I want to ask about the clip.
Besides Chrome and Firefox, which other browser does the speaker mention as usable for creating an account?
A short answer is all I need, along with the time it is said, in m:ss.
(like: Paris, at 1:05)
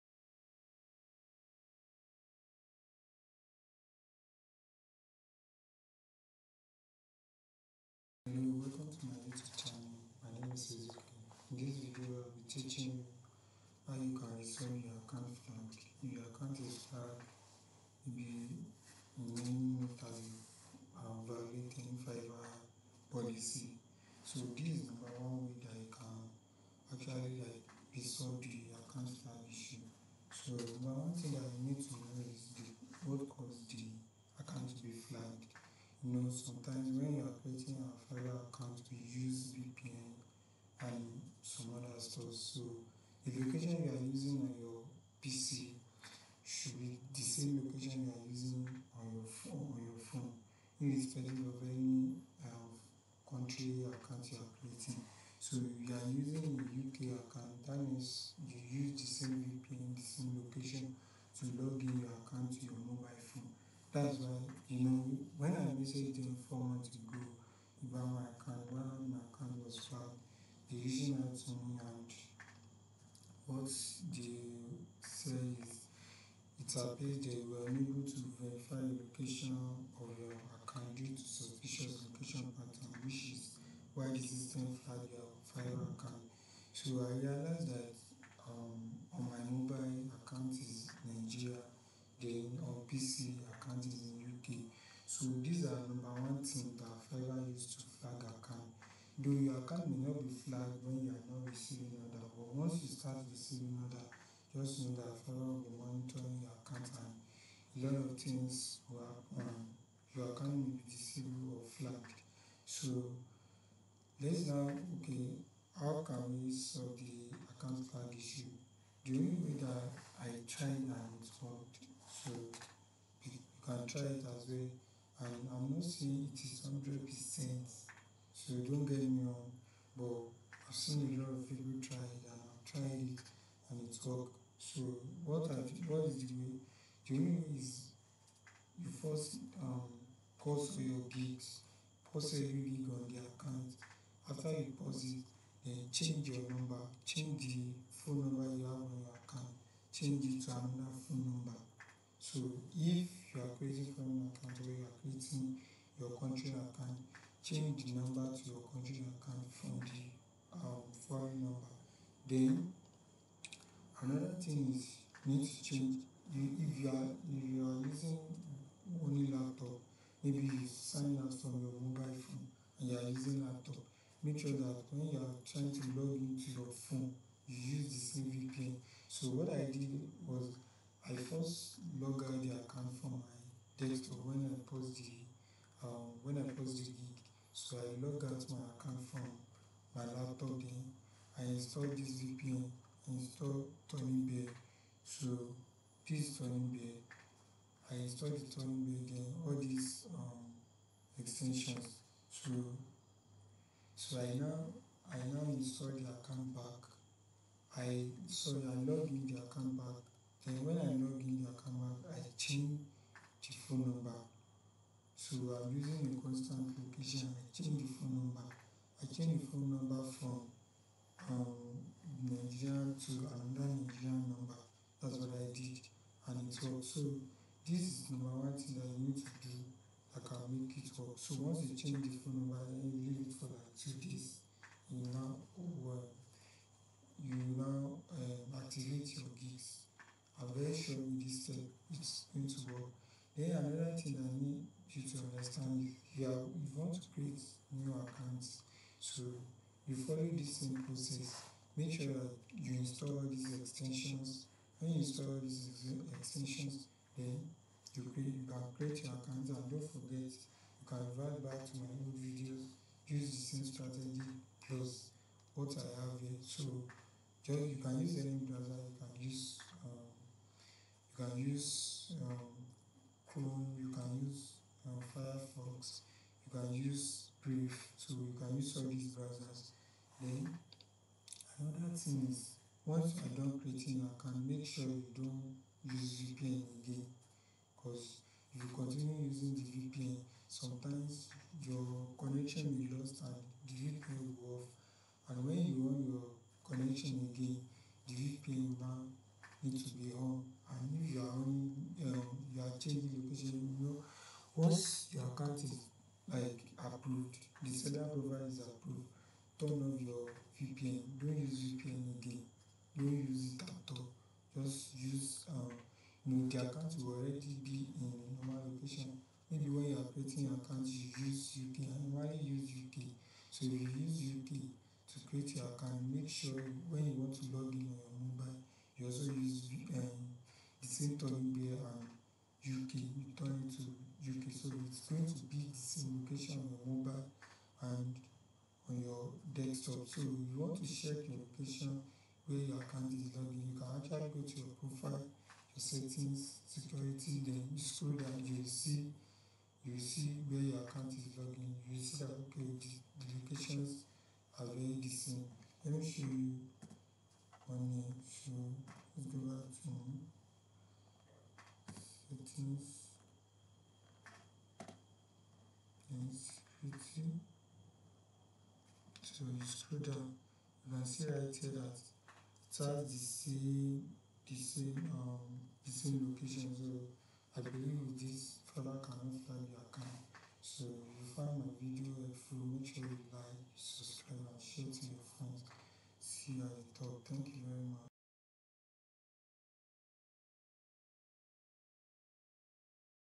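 Brave, at 4:37.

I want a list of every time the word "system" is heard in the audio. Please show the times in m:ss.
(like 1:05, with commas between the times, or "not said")
1:24.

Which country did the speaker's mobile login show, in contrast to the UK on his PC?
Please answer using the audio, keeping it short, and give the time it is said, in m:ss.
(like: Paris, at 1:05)
Nigeria, at 1:31.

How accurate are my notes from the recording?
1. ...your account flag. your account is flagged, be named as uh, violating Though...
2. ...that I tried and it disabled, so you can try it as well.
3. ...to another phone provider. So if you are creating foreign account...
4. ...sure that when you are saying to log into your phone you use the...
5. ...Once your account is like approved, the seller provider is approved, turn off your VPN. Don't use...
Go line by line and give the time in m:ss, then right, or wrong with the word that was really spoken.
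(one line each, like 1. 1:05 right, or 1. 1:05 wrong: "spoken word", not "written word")
1. 0:14 wrong: "Fiverr", not "Though"
2. 1:59 wrong: "worked", not "disabled"
3. 2:30 wrong: "number", not "provider"
4. 2:54 wrong: "trying", not "saying"
5. 5:04 right.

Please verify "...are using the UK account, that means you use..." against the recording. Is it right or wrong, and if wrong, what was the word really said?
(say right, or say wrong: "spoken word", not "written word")
right.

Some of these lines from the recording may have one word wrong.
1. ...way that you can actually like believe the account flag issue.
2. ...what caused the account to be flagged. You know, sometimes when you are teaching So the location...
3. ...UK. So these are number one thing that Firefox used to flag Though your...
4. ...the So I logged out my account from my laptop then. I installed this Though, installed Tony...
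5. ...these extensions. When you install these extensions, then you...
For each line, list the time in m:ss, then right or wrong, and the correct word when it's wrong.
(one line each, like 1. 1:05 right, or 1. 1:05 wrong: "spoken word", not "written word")
1. 0:25 wrong: "resolve", not "believe"
2. 0:33 wrong: "creating", not "teaching"
3. 1:34 wrong: "Fiverr", not "Firefox"
4. 3:06 wrong: "VPN", not "Though"
5. 4:13 right.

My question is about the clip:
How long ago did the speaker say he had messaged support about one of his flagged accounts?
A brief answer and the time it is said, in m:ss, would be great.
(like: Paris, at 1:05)
4 months, at 1:06.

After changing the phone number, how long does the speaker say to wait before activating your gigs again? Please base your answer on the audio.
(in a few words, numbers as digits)
2 days.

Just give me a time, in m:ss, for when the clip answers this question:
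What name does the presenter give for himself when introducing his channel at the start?
0:10.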